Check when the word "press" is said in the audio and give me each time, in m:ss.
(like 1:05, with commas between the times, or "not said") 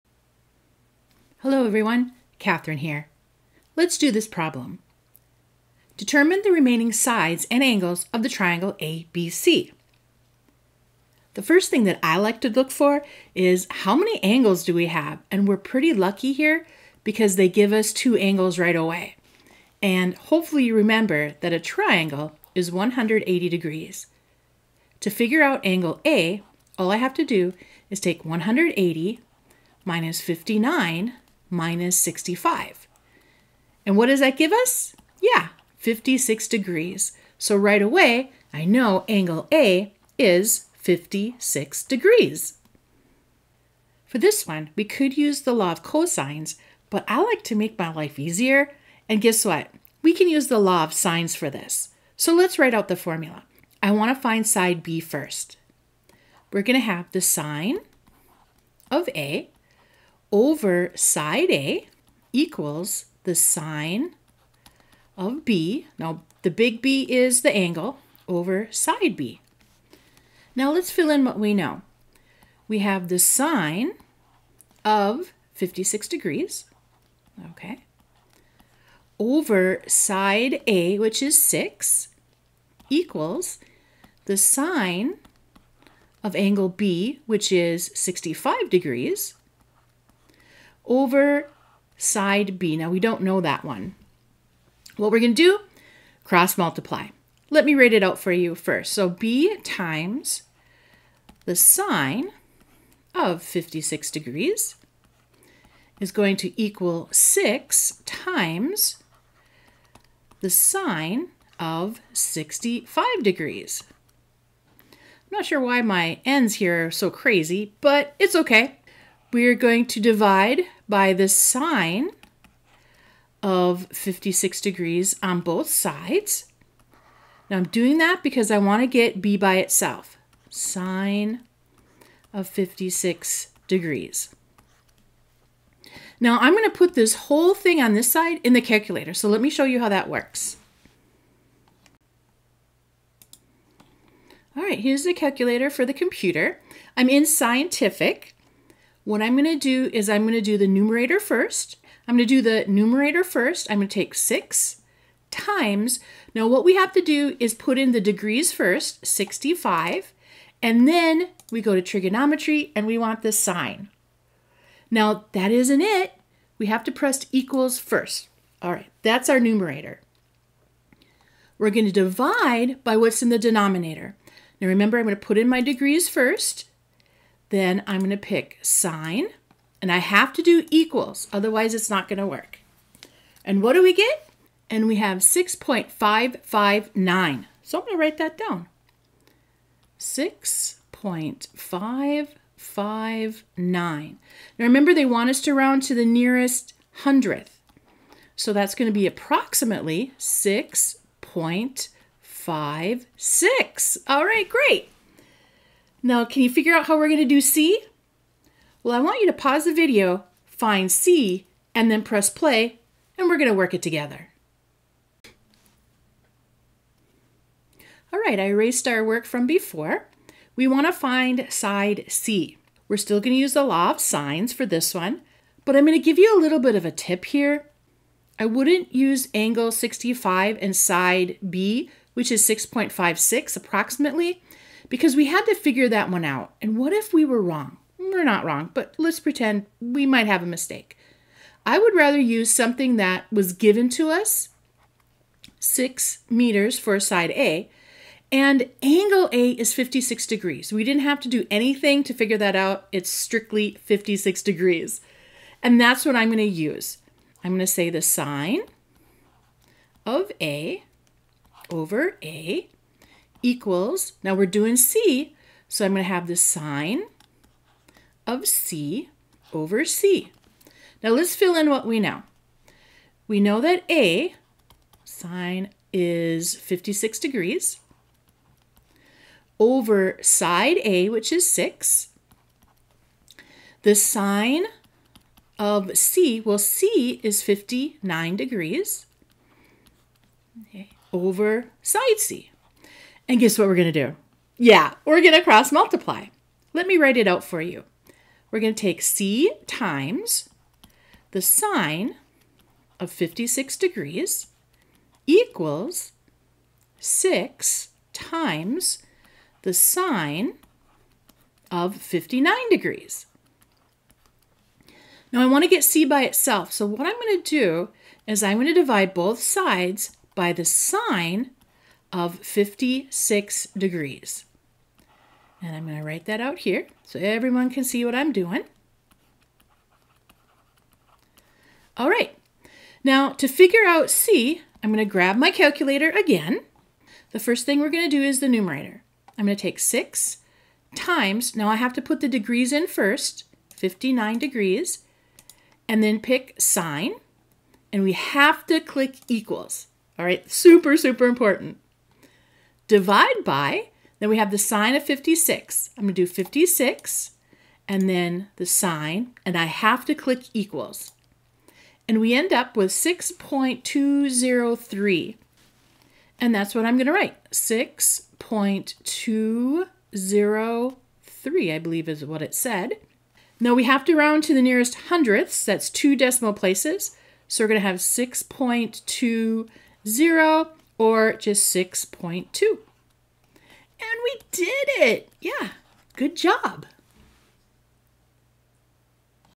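2:46, 3:32.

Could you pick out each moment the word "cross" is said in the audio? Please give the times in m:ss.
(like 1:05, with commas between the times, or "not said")
1:36, 4:55.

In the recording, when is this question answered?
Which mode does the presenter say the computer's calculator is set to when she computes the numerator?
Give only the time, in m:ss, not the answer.
2:27.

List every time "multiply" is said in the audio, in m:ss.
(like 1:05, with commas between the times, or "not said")
1:36, 4:55.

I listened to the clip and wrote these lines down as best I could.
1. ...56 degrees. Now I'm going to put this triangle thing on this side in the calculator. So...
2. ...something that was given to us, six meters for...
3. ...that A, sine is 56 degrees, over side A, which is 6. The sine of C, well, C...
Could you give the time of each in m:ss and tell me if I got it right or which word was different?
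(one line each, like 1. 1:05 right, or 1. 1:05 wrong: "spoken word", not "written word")
1. 2:12 wrong: "whole", not "triangle"
2. 4:02 right
3. 4:33 right.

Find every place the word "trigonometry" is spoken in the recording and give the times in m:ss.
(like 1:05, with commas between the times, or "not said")
2:41.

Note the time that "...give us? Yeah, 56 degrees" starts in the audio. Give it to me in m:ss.
0:34.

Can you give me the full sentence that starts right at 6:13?
Now we have to round to the nearest hundredths.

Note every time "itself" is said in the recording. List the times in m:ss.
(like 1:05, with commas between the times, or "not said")
2:09, 5:16.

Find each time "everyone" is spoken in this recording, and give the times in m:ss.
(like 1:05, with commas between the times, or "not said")
0:01, 5:27.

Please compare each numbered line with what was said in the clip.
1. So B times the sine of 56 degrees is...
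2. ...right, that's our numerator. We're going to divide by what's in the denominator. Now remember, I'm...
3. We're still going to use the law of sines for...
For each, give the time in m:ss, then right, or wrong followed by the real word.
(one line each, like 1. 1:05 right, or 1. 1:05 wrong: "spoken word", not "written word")
1. 1:38 right
2. 2:48 right
3. 3:42 right.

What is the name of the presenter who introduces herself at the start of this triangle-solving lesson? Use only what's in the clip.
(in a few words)
Catherine.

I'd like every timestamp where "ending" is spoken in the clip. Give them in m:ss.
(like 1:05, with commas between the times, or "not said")
not said.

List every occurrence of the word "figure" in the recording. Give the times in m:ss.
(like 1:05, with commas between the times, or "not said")
0:25, 3:26, 3:55, 4:12, 5:33.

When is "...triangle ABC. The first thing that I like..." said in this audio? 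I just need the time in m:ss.
0:08.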